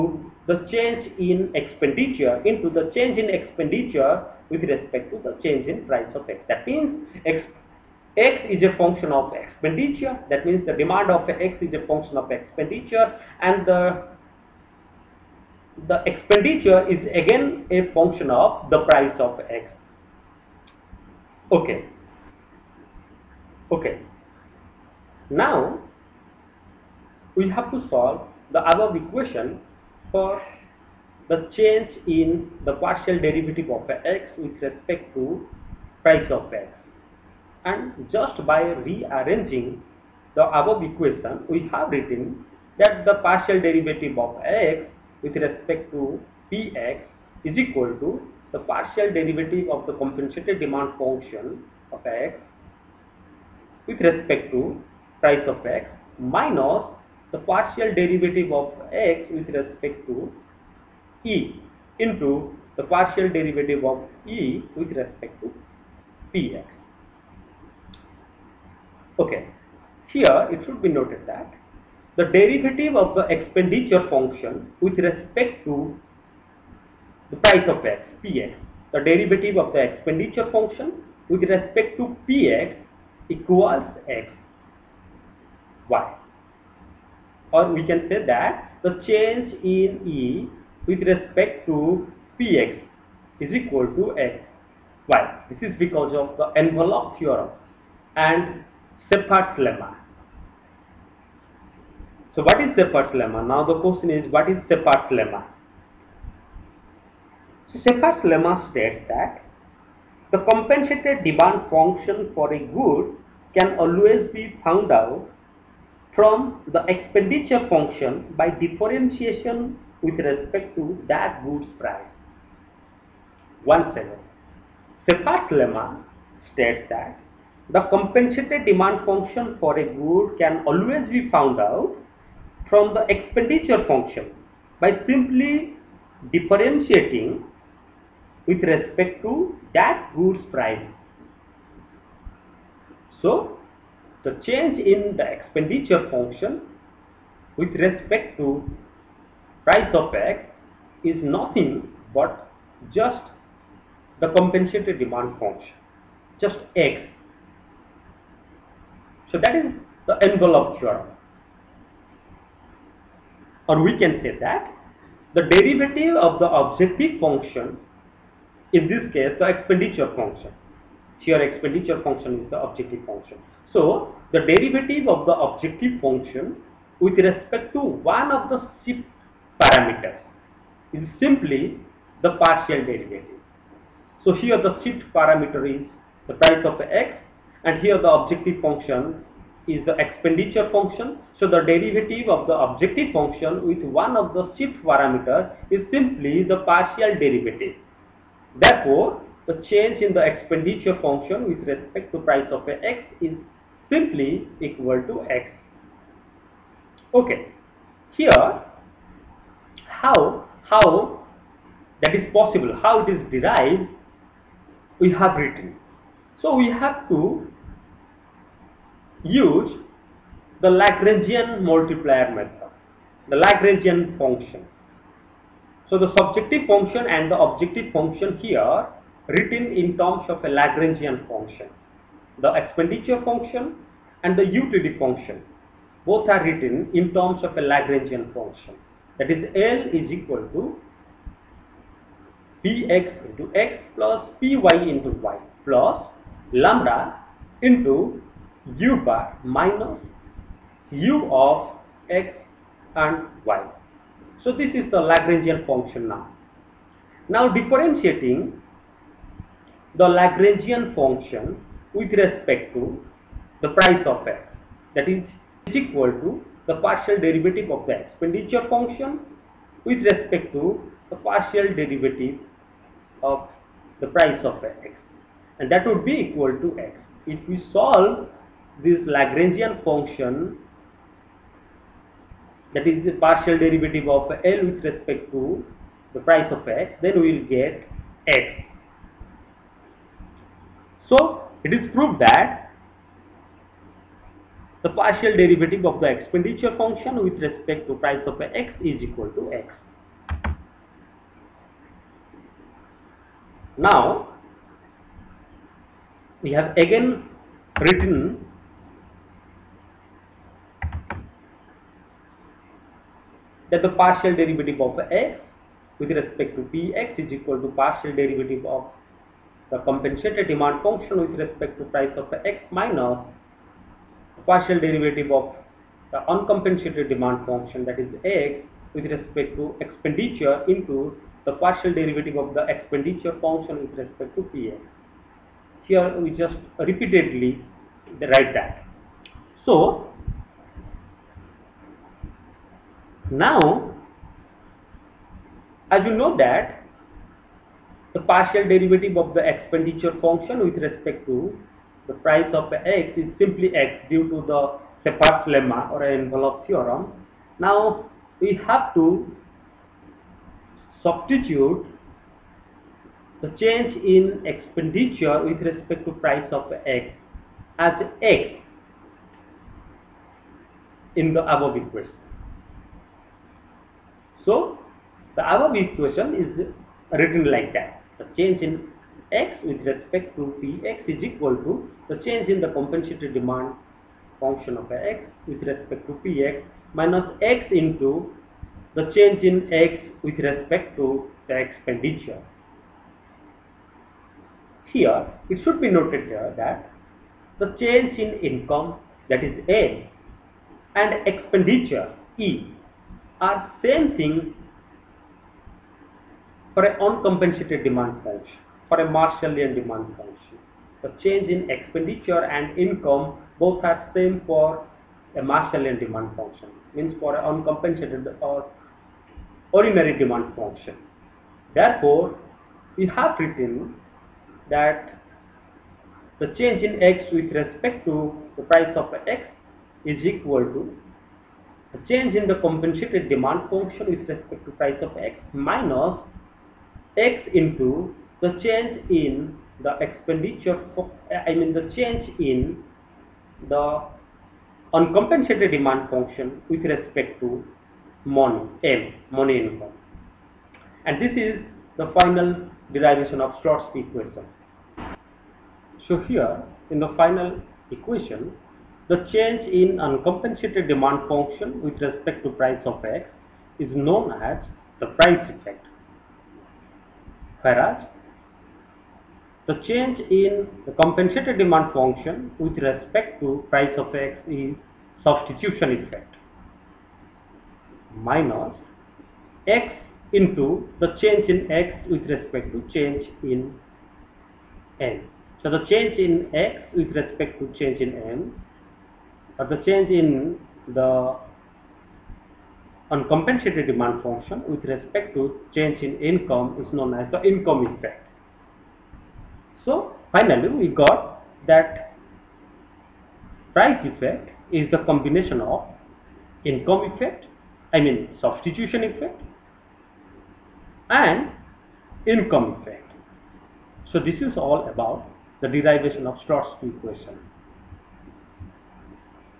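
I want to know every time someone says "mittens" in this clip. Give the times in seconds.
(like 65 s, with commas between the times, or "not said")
not said.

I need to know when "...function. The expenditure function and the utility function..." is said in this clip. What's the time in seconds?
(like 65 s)
231 s.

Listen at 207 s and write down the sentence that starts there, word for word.
Okay, here how how that is possible, how it is derived, we have written.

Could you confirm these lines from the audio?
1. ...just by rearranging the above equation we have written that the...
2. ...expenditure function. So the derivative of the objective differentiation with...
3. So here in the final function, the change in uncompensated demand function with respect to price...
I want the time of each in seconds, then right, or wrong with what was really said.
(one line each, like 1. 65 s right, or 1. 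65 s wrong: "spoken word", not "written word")
1. 38 s right
2. 189 s wrong: "function", not "differentiation"
3. 456 s wrong: "equation", not "function".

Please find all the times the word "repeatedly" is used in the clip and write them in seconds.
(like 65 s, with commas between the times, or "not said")
336 s.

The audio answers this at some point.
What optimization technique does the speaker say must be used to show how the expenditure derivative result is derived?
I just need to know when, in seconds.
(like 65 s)
220 s.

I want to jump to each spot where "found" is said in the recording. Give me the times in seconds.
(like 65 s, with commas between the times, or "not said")
114 s, 131 s.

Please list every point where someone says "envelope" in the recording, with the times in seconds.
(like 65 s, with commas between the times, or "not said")
96 s, 160 s, 356 s.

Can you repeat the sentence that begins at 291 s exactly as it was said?
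So it is proved that the partial derivative of the expenditure function with respect to price of x is equal to x.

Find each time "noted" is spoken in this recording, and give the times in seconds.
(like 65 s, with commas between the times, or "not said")
70 s, 395 s.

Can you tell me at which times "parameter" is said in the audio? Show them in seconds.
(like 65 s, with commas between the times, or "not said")
179 s, 185 s, 194 s.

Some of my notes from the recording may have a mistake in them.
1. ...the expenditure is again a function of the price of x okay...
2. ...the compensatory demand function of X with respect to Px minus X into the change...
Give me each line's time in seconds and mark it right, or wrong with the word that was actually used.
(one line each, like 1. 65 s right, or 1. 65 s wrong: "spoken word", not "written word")
1. 15 s right
2. 382 s right.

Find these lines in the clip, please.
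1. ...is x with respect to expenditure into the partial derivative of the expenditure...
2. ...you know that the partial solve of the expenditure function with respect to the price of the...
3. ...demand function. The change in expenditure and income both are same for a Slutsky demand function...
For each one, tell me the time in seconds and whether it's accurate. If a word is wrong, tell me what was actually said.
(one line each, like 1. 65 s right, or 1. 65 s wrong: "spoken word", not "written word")
1. 327 s right
2. 346 s wrong: "derivative", not "solve"
3. 409 s wrong: "Marshallian", not "Slutsky".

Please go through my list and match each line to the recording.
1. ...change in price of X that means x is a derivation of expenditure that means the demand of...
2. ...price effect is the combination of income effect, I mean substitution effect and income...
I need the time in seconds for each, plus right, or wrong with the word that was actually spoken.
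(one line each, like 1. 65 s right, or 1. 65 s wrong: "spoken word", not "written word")
1. 5 s wrong: "function", not "derivation"
2. 503 s right.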